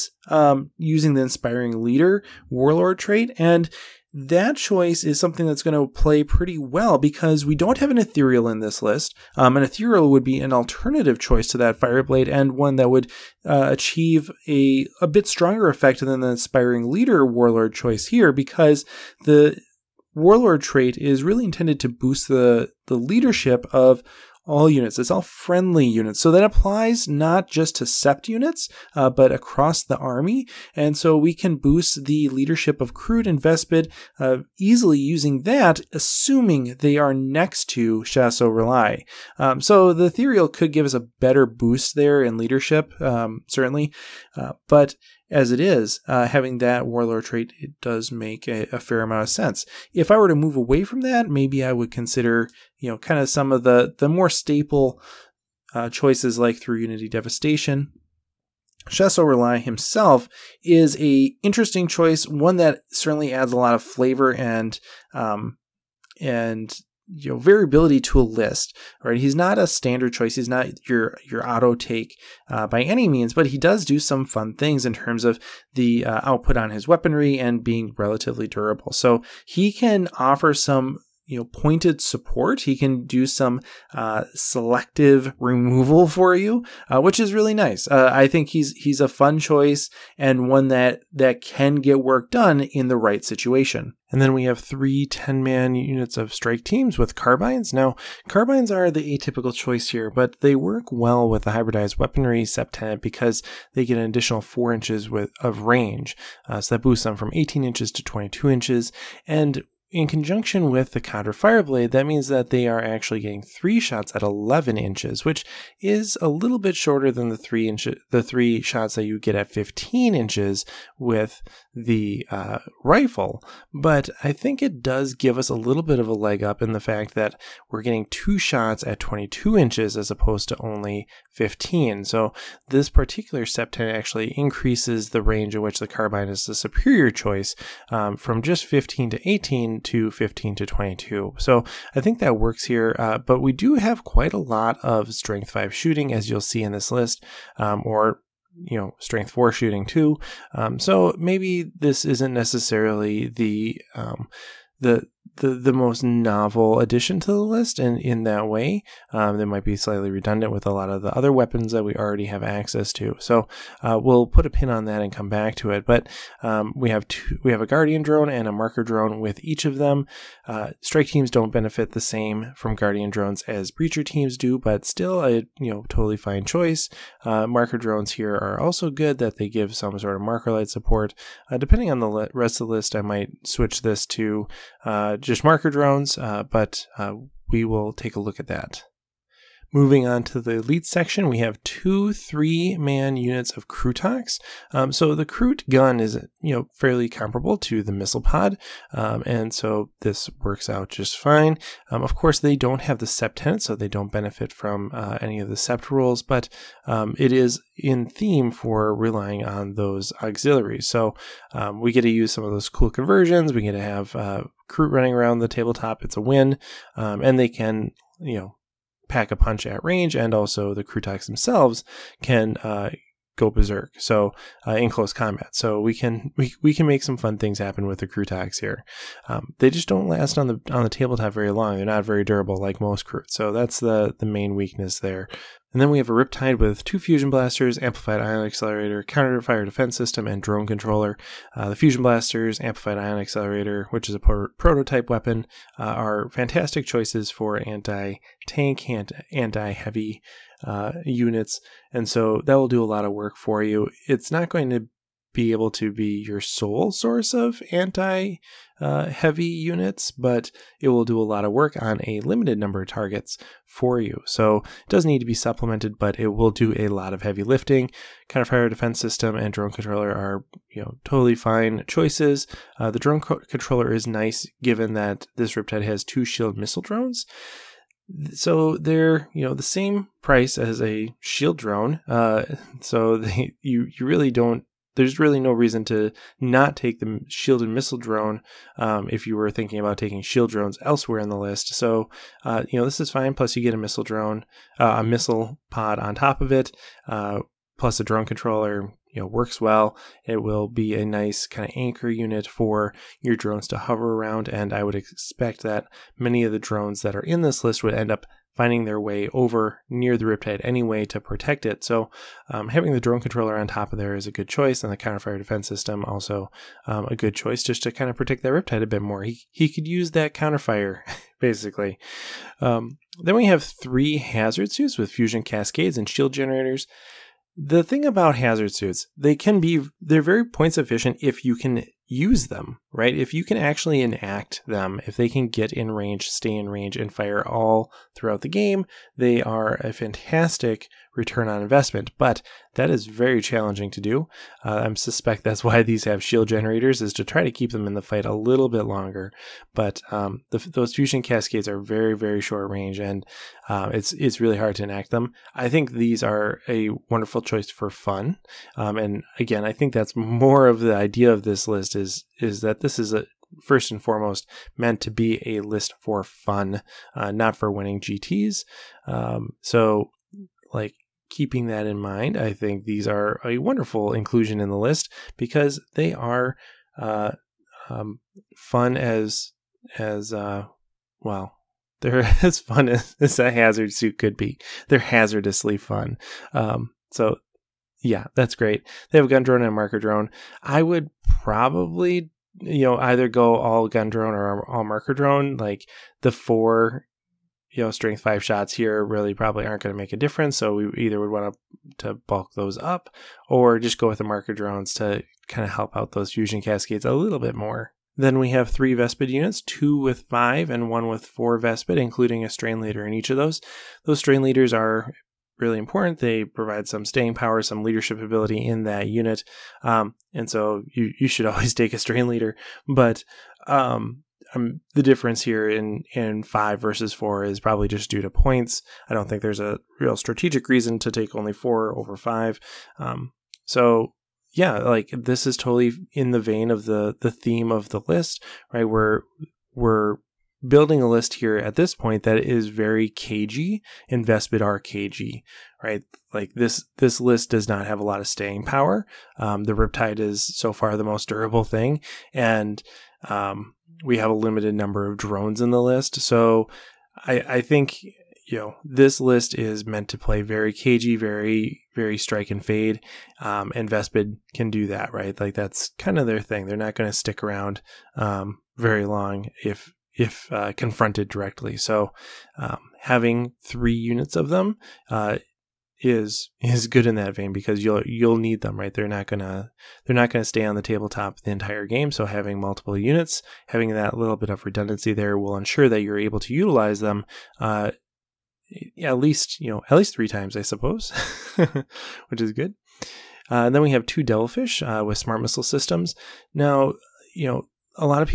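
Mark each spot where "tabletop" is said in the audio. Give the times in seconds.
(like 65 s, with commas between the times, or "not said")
215 s, 230 s, 480 s.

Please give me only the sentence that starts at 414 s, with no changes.
Those strain leaders are really important.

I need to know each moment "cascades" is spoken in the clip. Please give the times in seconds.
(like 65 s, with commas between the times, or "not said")
325 s, 351 s, 406 s.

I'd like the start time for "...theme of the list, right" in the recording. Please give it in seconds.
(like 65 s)
437 s.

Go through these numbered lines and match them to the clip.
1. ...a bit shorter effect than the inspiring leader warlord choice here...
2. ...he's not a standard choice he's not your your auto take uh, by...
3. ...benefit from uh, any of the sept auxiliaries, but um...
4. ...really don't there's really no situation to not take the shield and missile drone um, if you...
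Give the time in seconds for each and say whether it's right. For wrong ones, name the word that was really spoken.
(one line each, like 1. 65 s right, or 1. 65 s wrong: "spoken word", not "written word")
1. 15 s wrong: "stronger", not "shorter"
2. 69 s right
3. 204 s wrong: "rules", not "auxiliaries"
4. 284 s wrong: "reason", not "situation".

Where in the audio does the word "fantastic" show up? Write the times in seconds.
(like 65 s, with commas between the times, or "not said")
246 s, 339 s.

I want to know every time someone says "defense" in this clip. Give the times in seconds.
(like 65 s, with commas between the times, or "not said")
239 s, 268 s, 315 s.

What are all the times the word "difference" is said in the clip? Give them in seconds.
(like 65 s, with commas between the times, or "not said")
400 s, 425 s.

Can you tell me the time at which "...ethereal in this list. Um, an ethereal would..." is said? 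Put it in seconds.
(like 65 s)
7 s.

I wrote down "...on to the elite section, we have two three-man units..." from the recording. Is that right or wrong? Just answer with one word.
right.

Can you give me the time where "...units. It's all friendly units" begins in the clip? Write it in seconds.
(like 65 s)
24 s.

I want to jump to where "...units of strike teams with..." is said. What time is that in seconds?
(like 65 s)
95 s.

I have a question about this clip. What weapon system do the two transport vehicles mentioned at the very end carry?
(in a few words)
smart missile systems.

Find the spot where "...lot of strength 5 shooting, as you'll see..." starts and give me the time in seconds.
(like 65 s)
144 s.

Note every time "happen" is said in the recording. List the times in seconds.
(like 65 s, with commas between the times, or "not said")
227 s.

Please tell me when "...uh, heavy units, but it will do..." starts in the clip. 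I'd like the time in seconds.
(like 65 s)
258 s.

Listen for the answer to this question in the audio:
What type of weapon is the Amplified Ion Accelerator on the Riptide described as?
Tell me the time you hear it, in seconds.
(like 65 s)
244 s.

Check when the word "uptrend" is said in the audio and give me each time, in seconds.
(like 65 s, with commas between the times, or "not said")
not said.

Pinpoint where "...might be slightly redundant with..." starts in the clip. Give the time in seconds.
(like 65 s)
159 s.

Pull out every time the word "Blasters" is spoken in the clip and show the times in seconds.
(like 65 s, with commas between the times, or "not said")
237 s, 241 s.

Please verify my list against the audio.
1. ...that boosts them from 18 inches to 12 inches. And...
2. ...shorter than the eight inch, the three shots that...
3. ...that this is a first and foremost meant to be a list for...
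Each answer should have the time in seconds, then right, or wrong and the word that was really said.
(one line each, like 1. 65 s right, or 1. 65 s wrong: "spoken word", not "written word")
1. 106 s wrong: "22", not "12"
2. 116 s wrong: "three", not "eight"
3. 362 s right.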